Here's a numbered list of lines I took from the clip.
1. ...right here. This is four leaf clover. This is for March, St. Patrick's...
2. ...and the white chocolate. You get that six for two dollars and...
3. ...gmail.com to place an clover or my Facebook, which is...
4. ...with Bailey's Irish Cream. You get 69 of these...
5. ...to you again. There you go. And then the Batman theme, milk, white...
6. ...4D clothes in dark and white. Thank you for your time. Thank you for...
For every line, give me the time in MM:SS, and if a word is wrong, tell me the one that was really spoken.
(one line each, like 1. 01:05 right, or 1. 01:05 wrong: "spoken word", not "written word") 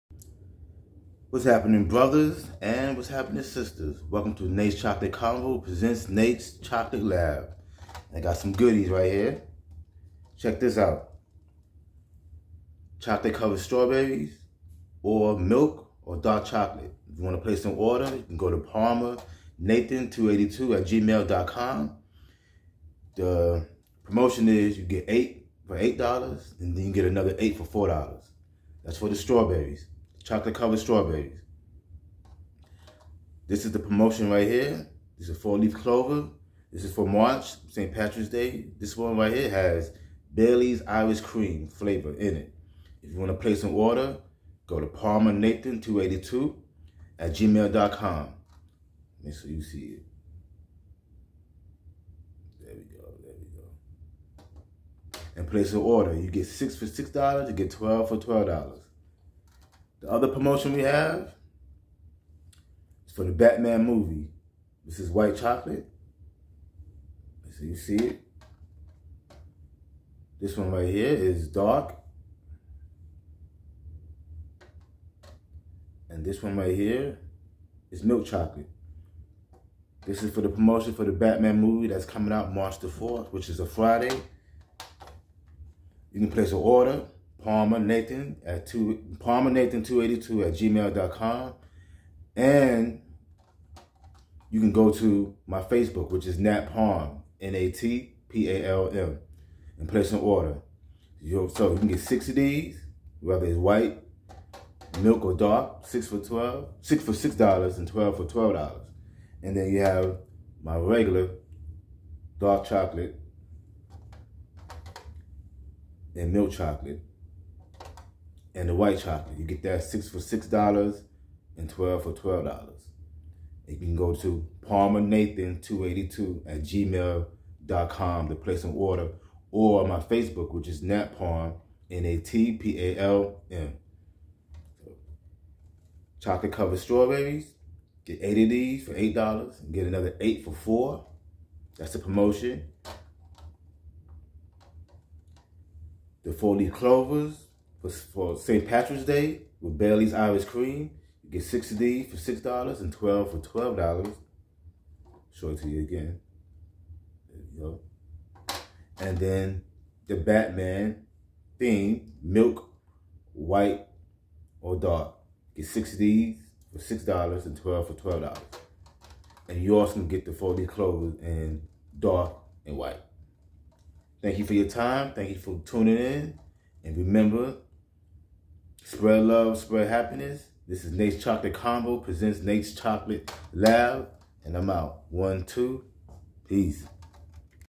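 1. 00:34 right
2. 01:58 wrong: "six", not "two"
3. 02:06 wrong: "order", not "clover"
4. 02:29 wrong: "60", not "69"
5. 02:35 right
6. 02:50 right.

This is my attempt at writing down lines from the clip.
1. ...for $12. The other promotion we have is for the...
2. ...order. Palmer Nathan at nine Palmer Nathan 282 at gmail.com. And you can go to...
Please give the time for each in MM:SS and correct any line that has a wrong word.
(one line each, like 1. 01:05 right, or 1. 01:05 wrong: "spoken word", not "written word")
1. 00:58 right
2. 01:26 wrong: "two", not "nine".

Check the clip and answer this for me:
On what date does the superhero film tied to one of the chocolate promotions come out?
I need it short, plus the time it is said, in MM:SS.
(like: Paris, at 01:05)
March 4th, at 01:22.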